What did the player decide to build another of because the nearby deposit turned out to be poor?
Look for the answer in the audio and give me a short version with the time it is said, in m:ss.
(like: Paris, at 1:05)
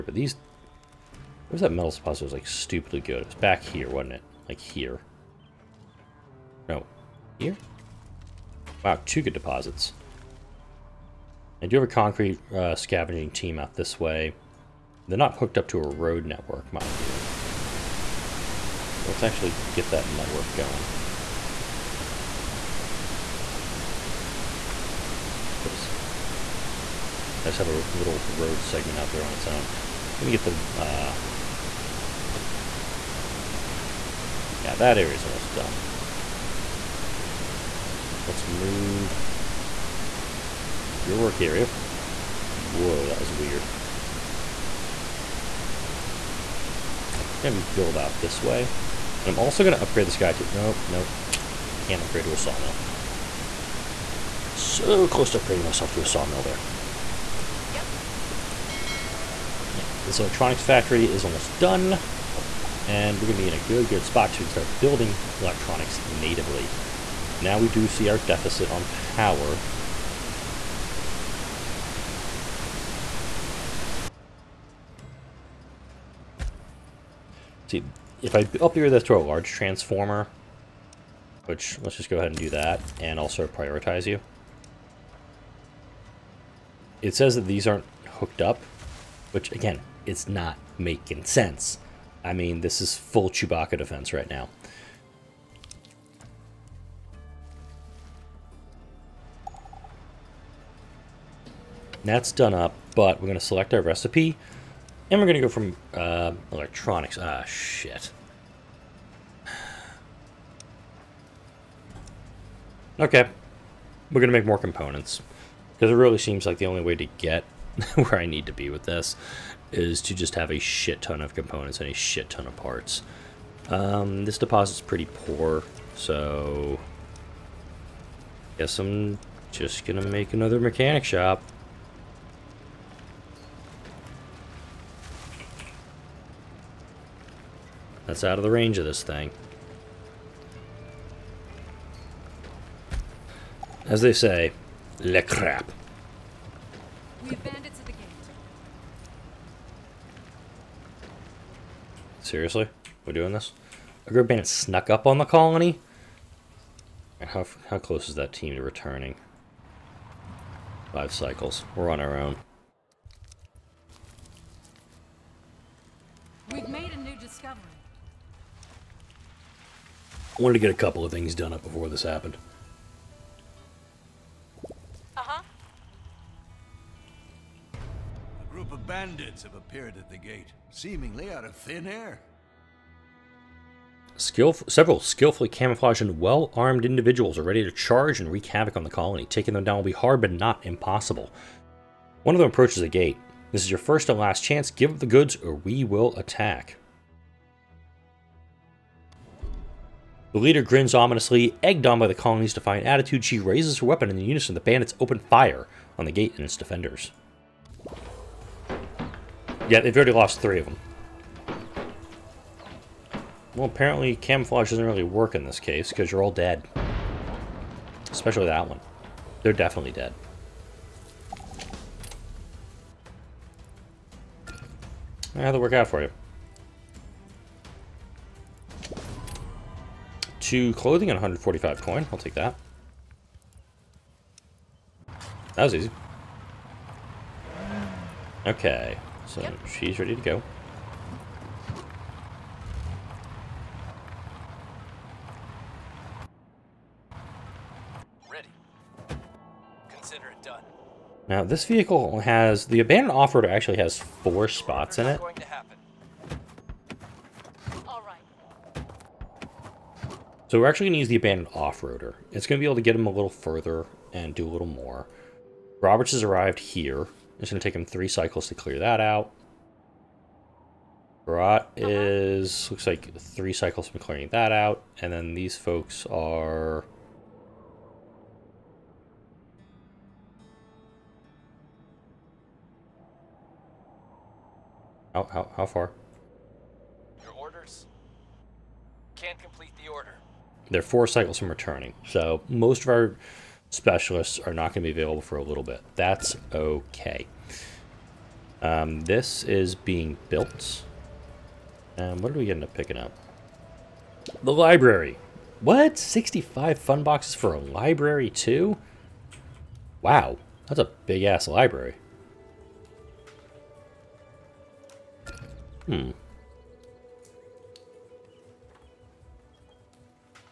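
mechanic shop, at 2:10.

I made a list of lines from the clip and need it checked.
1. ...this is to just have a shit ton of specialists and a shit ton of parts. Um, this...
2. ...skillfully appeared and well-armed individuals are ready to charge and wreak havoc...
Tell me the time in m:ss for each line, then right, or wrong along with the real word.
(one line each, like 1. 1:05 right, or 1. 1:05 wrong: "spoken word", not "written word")
1. 1:58 wrong: "components", not "specialists"
2. 3:05 wrong: "camouflaged", not "appeared".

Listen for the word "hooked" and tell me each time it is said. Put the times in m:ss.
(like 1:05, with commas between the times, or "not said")
0:15, 1:28.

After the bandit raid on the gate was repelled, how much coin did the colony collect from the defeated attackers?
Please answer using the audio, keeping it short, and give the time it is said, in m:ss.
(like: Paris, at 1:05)
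145, at 3:51.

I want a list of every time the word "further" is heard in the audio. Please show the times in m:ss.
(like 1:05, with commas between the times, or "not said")
4:23.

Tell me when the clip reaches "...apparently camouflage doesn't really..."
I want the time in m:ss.
3:33.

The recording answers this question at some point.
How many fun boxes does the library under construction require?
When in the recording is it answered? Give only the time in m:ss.
5:05.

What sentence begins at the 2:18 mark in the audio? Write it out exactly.
That's out of the range of this thing.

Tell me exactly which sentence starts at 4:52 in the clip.
So most of our specialists are not going to be available for a little bit.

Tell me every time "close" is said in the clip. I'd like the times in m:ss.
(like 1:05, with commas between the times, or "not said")
0:55, 2:37.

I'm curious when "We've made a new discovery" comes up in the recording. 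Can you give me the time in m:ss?
2:46.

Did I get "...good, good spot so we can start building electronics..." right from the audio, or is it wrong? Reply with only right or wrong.
right.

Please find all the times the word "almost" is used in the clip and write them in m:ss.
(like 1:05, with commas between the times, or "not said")
0:35, 1:01.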